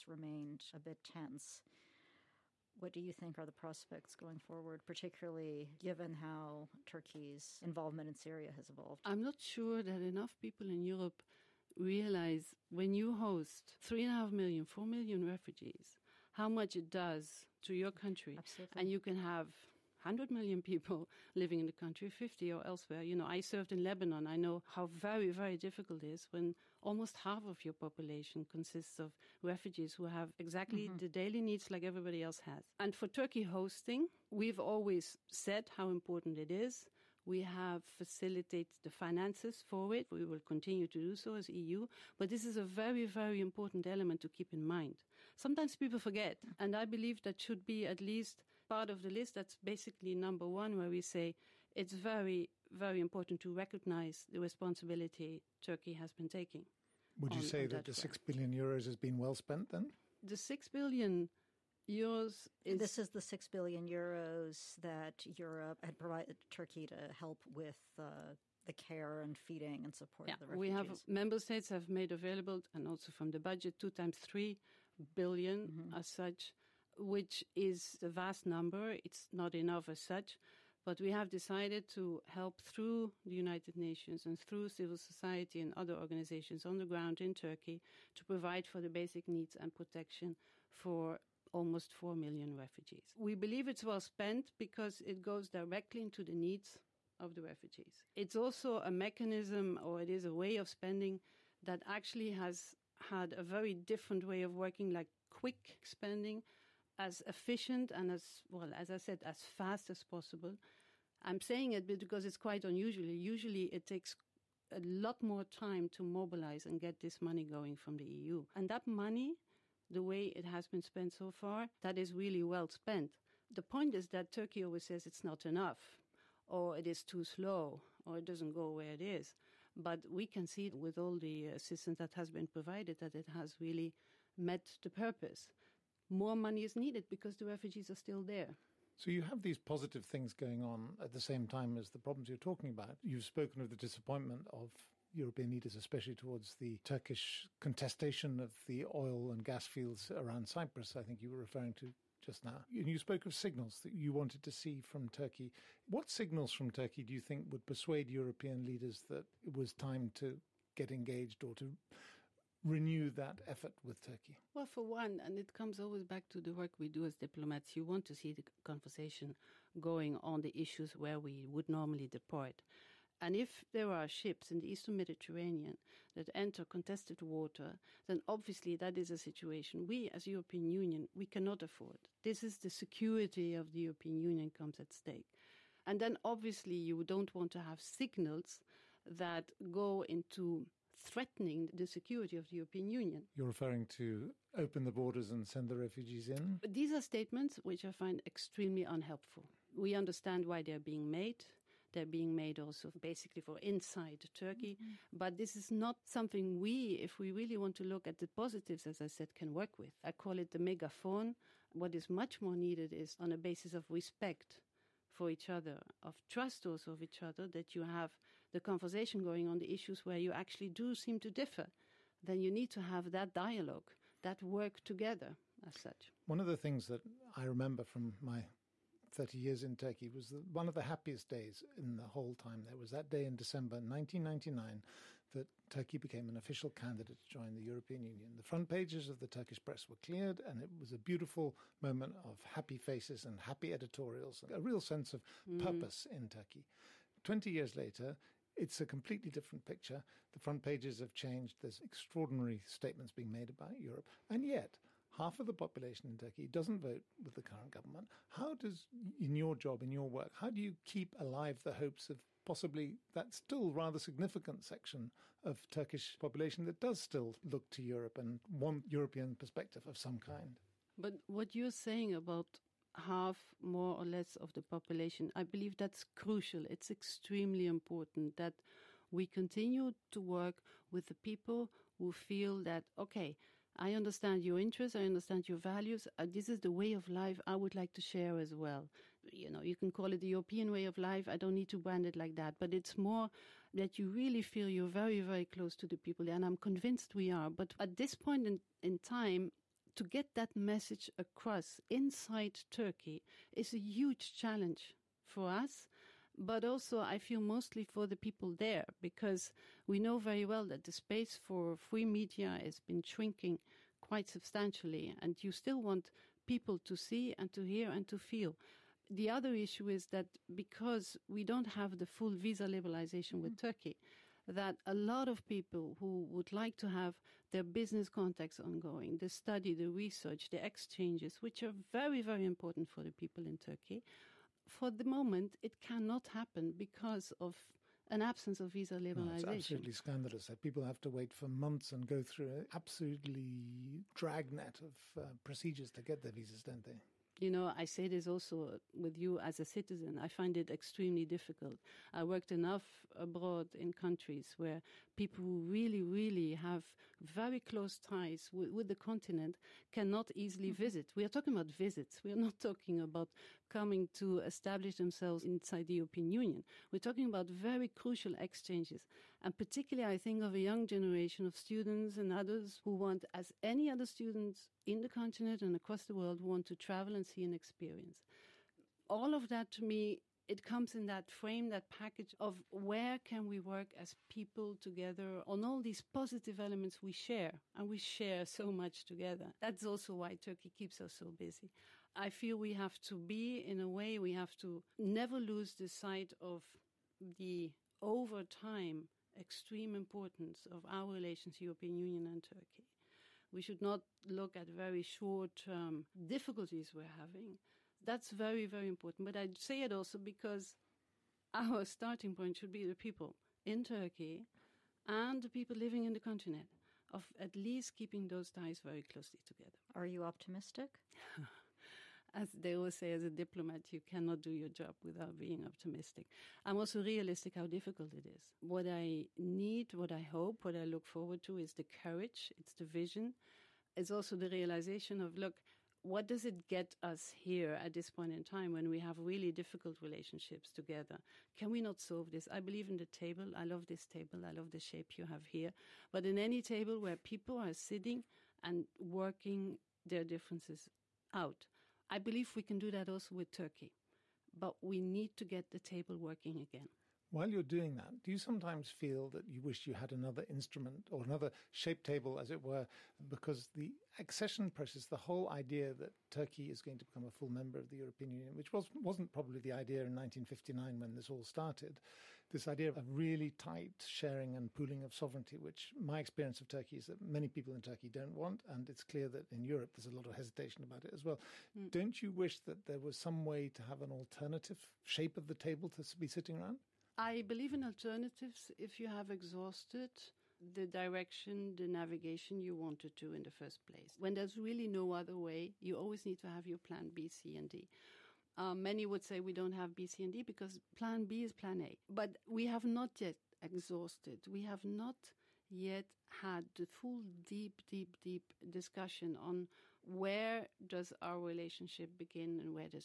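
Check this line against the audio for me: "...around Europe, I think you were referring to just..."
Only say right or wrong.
wrong.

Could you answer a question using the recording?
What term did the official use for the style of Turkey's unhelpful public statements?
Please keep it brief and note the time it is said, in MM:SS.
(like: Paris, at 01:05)
the megaphone, at 03:30.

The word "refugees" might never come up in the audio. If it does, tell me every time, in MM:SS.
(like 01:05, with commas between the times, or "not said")
00:15, 00:29, 01:10, 01:32, 01:37, 02:17, 03:15.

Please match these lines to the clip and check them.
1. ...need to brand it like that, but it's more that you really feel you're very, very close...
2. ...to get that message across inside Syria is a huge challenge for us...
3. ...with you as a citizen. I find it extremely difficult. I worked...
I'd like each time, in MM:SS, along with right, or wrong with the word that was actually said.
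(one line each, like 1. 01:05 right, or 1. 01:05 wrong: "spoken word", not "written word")
1. 04:51 right
2. 04:59 wrong: "Turkey", not "Syria"
3. 05:48 right.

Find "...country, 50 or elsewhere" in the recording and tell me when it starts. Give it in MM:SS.
00:21.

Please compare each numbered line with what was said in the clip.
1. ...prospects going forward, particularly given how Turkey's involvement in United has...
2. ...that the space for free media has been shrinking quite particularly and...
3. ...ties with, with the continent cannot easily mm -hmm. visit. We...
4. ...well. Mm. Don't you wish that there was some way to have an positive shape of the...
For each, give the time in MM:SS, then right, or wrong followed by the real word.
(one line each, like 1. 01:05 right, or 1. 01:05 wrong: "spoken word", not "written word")
1. 00:03 wrong: "Syria", not "United"
2. 05:10 wrong: "substantially", not "particularly"
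3. 05:57 right
4. 08:01 wrong: "alternative", not "positive".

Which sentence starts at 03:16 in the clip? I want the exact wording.
these are statements which I find extremely unhelpful.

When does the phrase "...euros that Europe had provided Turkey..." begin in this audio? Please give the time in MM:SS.
01:03.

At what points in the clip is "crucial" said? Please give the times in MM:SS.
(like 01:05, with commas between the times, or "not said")
04:36, 06:07.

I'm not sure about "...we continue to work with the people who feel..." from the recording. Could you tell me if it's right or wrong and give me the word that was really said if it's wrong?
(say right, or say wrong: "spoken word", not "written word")
right.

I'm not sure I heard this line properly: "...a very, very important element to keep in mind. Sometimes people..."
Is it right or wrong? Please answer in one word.
right.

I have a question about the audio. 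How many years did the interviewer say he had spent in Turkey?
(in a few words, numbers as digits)
30 years.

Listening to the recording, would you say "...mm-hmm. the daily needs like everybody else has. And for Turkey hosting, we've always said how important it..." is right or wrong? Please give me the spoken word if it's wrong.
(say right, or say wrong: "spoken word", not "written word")
right.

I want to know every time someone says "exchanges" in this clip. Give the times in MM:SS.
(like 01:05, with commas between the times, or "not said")
05:30, 06:08.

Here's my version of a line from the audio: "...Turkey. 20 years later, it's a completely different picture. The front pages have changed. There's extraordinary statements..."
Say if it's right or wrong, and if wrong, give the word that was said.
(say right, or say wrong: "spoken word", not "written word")
right.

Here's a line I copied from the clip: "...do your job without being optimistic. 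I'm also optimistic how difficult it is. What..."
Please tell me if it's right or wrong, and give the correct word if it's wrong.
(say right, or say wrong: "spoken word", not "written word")
wrong: "realistic", not "optimistic".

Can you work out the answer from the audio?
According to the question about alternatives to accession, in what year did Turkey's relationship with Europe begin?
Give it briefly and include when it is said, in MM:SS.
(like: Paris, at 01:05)
1959, at 07:50.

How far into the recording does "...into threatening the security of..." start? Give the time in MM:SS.
03:10.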